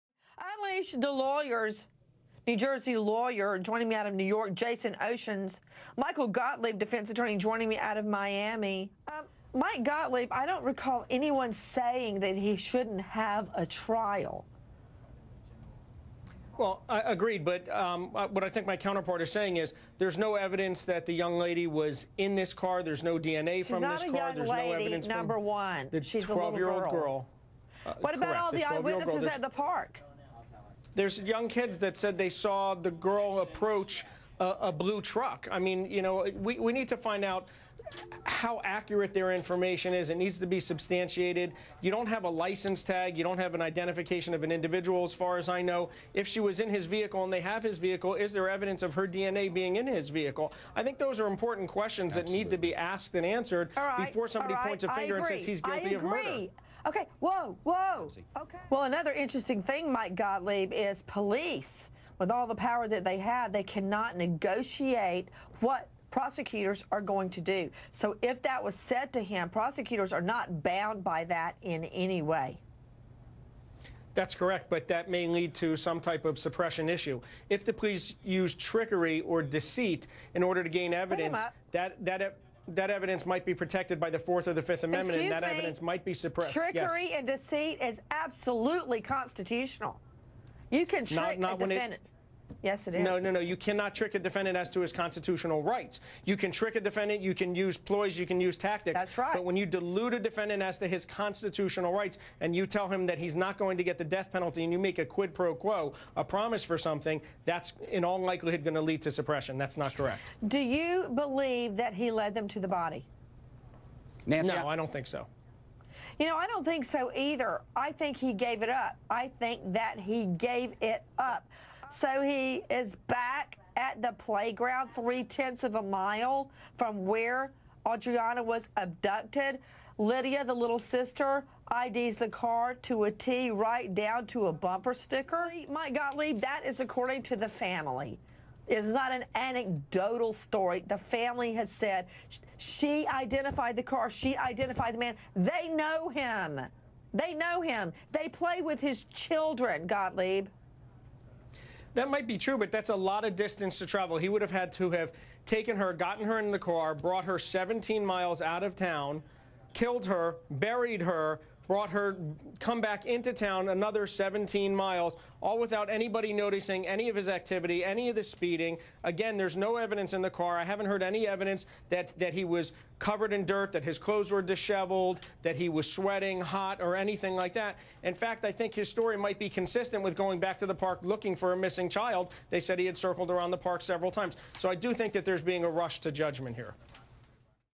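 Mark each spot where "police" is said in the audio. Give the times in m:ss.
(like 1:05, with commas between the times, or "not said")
1:01, 1:17.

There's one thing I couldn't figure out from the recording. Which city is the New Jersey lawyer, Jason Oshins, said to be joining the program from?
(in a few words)
New York.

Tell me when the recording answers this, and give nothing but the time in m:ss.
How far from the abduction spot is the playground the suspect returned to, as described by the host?
2:04.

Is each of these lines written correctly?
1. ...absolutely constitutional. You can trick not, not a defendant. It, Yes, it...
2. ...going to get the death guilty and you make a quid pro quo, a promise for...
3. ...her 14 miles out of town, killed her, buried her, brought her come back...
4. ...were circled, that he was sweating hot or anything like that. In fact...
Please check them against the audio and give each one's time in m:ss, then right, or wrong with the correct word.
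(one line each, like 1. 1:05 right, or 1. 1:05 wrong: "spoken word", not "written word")
1. 1:28 right
2. 1:43 wrong: "penalty", not "guilty"
3. 2:37 wrong: "17", not "14"
4. 2:54 wrong: "disheveled", not "circled".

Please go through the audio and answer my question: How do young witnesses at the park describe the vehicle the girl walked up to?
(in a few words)
a blue truck.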